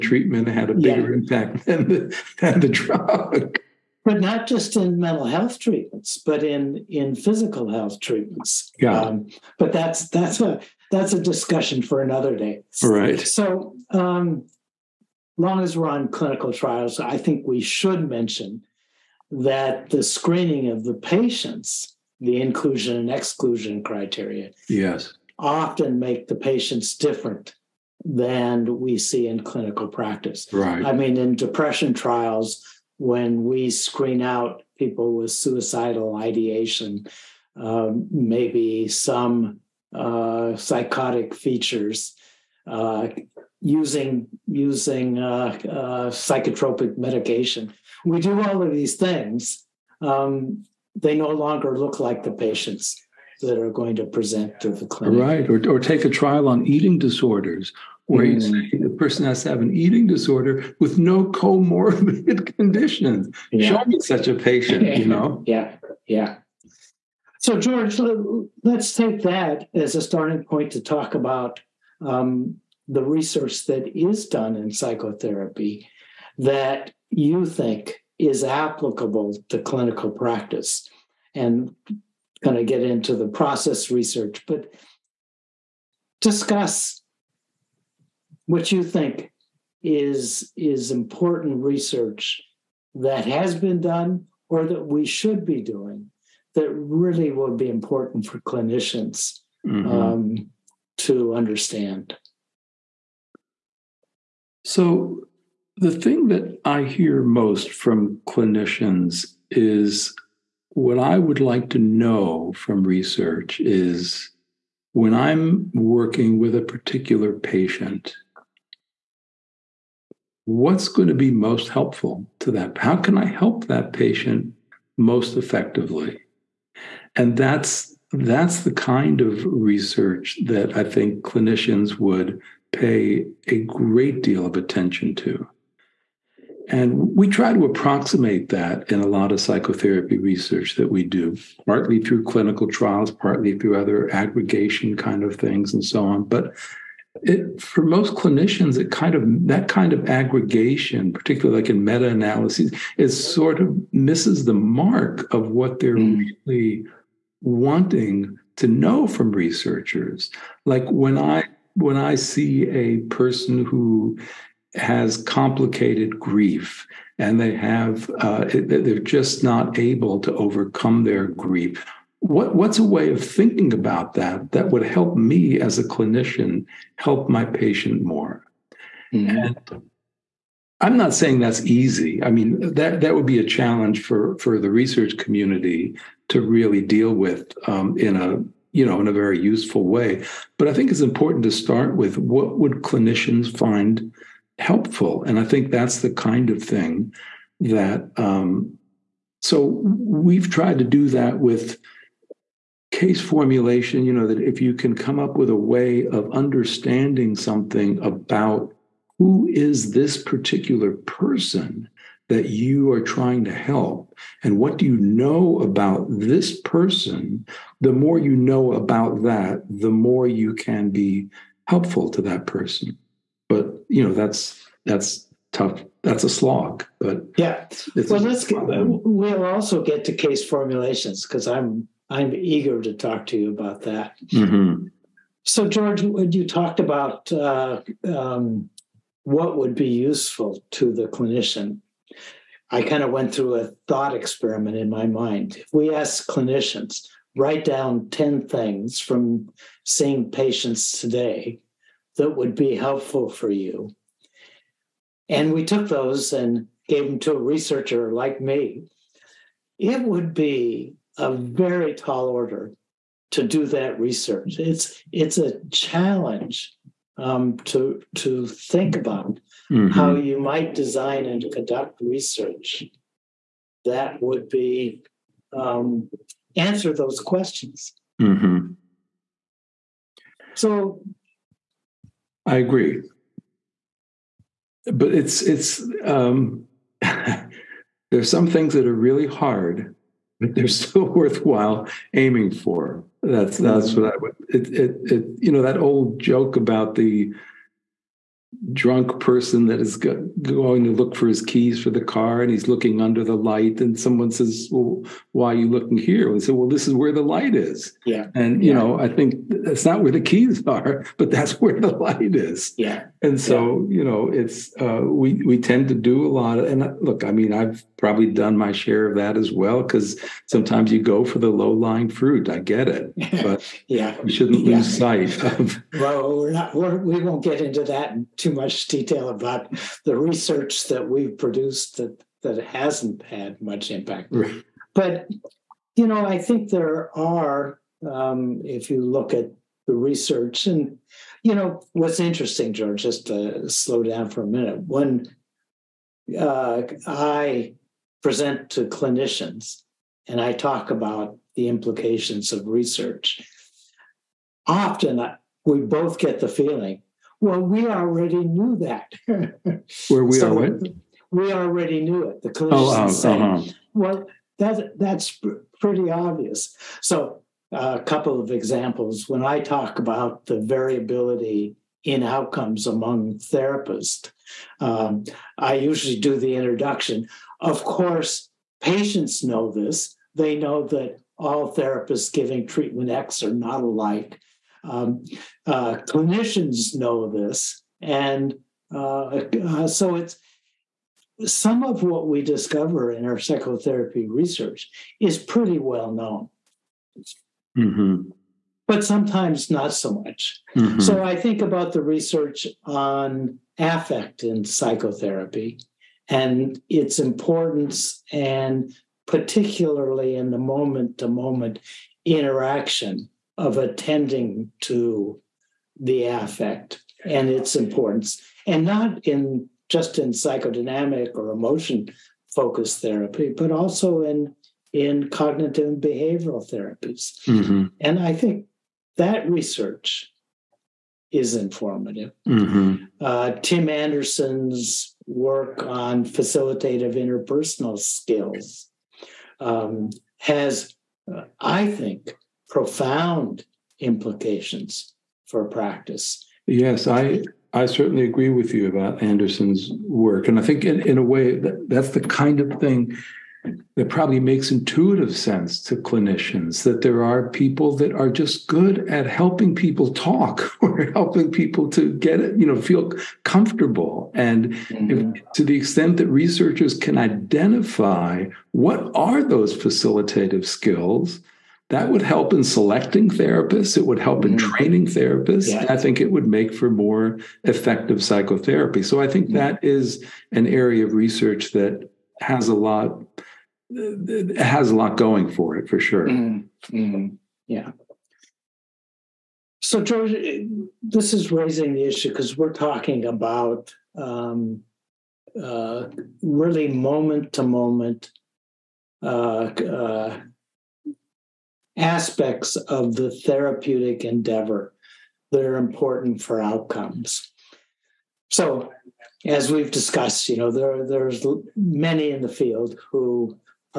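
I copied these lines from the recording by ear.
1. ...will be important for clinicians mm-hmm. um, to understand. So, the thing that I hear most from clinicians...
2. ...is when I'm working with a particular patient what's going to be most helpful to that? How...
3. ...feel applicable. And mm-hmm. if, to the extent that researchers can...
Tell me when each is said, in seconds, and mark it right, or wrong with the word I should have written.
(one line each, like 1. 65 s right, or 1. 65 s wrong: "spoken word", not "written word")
1. 97 s right
2. 113 s right
3. 462 s wrong: "comfortable", not "applicable".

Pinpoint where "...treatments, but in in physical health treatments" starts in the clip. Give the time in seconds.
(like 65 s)
5 s.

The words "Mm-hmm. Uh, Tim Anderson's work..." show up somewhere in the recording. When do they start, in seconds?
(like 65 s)
432 s.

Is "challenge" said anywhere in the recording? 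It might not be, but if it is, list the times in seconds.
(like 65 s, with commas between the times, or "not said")
183 s, 265 s.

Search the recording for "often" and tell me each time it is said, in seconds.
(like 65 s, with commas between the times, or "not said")
25 s, 354 s.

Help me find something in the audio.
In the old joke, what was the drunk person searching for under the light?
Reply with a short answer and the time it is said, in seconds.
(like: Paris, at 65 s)
Keys for the car, at 301 s.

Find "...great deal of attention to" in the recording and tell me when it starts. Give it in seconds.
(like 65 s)
133 s.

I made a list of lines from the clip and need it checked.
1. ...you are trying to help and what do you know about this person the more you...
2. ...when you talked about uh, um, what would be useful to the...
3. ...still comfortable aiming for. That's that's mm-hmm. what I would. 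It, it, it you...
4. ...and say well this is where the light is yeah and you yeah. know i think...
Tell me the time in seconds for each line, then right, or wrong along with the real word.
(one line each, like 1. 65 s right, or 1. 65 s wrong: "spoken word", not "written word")
1. 212 s right
2. 236 s right
3. 290 s wrong: "worthwhile", not "comfortable"
4. 306 s right.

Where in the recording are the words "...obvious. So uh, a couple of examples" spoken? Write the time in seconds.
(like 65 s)
366 s.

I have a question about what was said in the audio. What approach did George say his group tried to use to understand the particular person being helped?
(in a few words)
Case formulation.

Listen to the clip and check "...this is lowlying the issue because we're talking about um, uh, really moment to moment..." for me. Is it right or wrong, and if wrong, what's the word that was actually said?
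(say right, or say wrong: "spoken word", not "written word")
wrong: "raising", not "lowlying".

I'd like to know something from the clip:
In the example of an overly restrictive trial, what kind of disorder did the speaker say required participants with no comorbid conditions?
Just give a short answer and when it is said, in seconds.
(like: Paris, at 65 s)
Eating disorders, at 56 s.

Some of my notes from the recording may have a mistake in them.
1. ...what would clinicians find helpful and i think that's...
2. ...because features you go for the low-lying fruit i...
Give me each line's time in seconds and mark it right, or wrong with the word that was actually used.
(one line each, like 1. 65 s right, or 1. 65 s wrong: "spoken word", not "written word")
1. 192 s right
2. 319 s wrong: "sometimes", not "features".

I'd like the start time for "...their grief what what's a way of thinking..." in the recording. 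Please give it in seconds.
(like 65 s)
171 s.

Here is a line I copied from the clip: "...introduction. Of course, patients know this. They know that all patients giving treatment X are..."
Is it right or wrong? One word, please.
wrong.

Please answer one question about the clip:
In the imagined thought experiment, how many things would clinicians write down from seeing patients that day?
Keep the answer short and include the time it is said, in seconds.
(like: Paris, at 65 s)
10, at 248 s.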